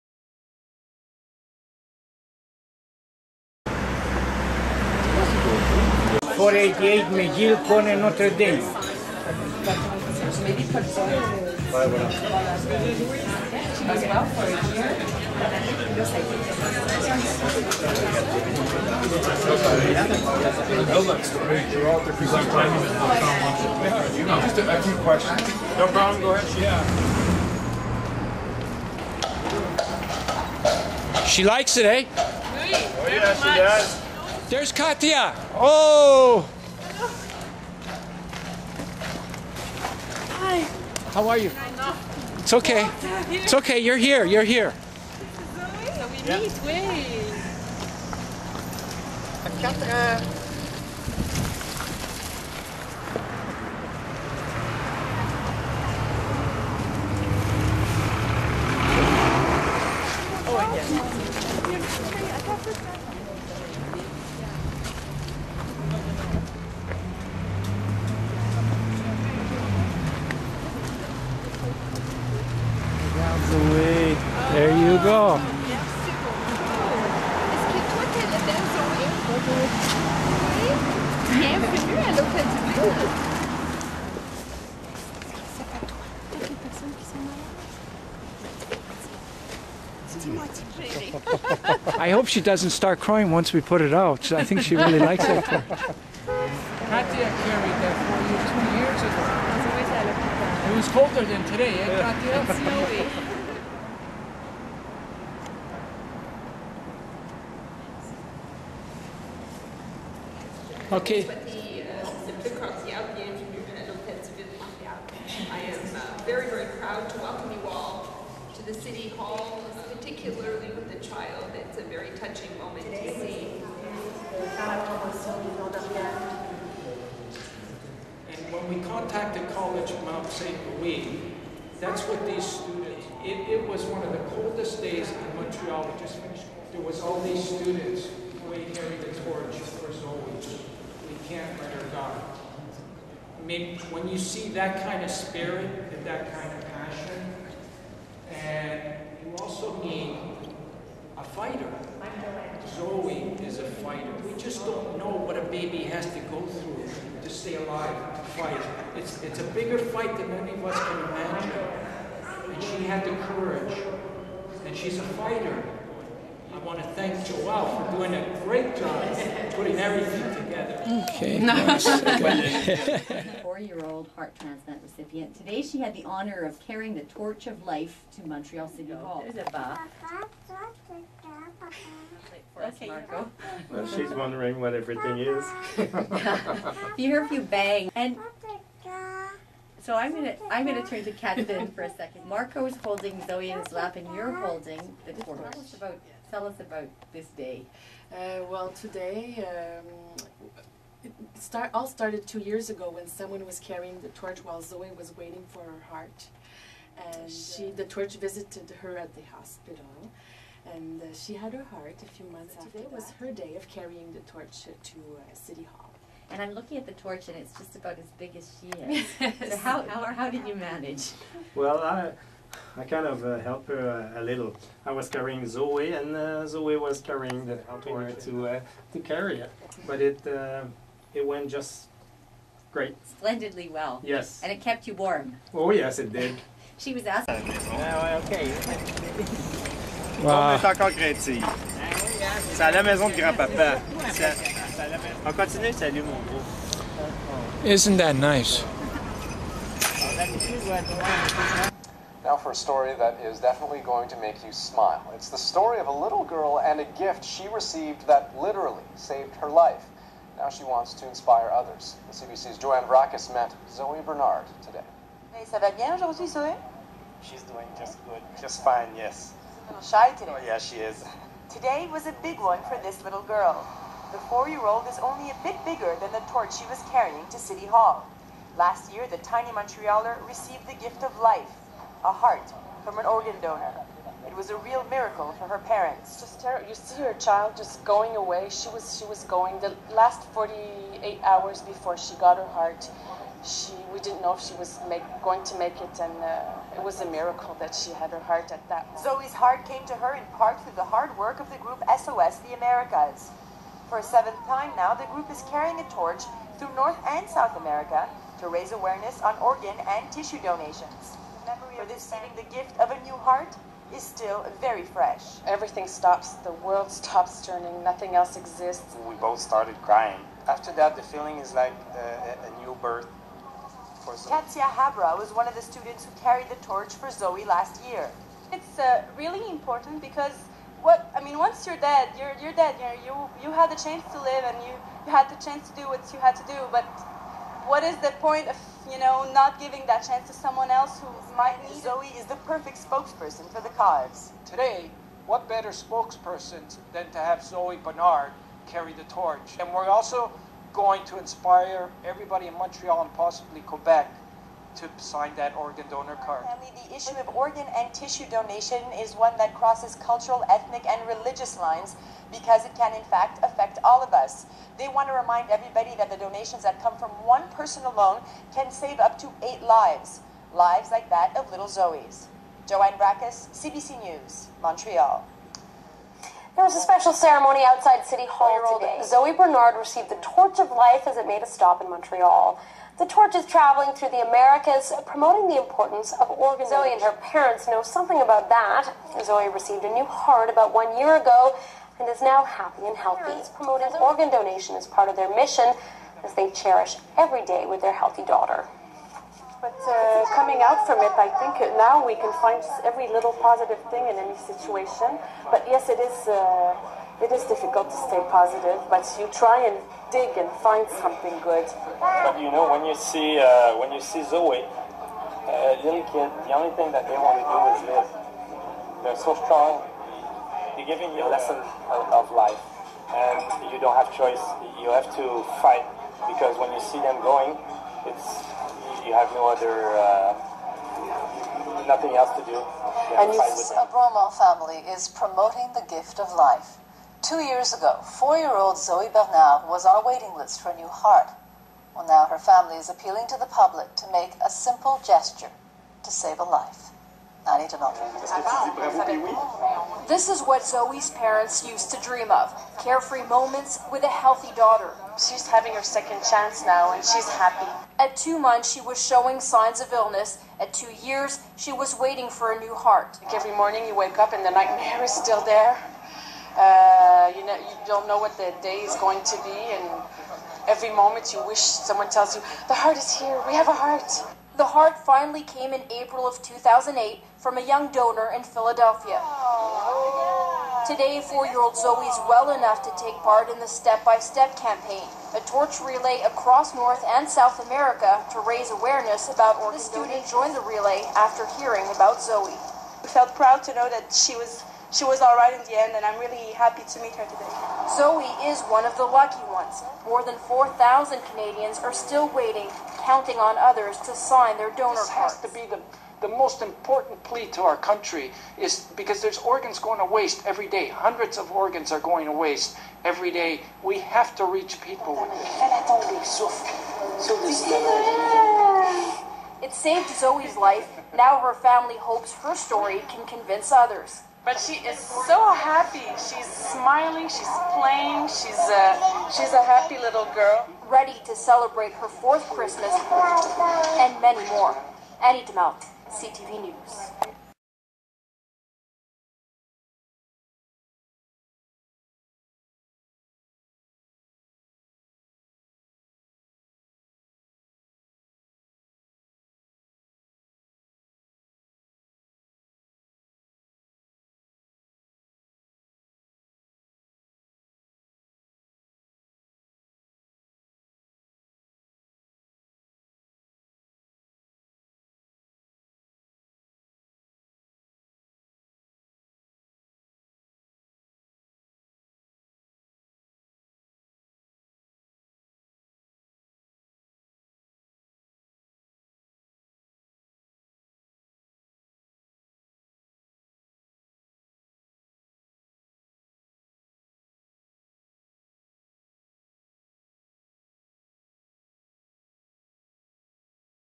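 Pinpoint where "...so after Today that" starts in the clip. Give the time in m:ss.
3:32.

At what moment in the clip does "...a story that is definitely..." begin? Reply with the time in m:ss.
4:12.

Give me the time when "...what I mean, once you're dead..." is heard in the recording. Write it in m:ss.
5:30.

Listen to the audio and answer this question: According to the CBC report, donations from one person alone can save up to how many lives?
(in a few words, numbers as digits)
8.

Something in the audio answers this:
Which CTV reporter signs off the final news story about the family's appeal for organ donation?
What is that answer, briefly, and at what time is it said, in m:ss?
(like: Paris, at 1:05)
Annie Demel, at 8:55.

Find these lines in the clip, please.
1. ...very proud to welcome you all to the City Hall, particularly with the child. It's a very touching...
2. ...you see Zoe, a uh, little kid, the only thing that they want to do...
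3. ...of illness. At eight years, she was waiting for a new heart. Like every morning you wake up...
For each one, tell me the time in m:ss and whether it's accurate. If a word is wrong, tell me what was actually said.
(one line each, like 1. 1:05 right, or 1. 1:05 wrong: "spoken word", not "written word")
1. 1:56 right
2. 6:53 right
3. 7:39 wrong: "two", not "eight".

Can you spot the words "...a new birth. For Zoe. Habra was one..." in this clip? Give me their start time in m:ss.
5:22.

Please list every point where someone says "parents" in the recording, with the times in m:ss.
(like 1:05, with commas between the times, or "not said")
4:45, 6:27, 6:33, 7:31.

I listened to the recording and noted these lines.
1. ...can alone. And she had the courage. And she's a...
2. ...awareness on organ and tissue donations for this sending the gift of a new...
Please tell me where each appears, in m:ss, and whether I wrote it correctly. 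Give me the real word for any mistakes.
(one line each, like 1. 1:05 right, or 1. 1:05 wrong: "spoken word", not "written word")
1. 2:40 wrong: "imagine", not "alone"
2. 5:08 right.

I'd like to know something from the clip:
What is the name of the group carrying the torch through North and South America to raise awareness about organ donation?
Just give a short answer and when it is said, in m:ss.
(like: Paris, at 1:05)
SOS The Americas, at 5:01.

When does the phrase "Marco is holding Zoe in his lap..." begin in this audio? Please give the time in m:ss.
3:12.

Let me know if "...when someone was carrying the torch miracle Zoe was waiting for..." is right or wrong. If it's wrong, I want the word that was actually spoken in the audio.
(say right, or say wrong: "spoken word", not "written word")
wrong: "while", not "miracle".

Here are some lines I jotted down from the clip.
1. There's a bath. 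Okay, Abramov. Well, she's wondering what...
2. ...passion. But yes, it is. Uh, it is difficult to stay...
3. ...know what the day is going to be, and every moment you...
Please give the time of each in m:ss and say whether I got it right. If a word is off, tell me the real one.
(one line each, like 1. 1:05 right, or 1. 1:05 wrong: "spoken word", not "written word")
1. 2:59 wrong: "Marco", not "Abramov"
2. 6:44 wrong: "situation", not "passion"
3. 7:48 right.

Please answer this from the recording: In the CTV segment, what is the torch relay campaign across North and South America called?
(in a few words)
Step by Step.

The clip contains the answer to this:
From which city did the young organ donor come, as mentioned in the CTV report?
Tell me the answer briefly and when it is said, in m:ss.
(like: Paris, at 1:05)
Philadelphia, at 7:58.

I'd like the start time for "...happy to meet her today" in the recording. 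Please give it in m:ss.
8:16.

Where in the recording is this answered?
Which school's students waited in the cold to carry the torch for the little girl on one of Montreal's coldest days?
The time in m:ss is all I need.
2:09.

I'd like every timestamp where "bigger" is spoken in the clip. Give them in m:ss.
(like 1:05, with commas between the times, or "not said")
2:39, 4:35.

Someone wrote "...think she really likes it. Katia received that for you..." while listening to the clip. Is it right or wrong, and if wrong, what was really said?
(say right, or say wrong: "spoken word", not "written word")
wrong: "carried", not "received".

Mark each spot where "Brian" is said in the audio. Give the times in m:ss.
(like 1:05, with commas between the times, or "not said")
not said.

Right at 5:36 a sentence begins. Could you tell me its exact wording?
But what is the point of you know, not giving that chance to someone else who might need Zoe it.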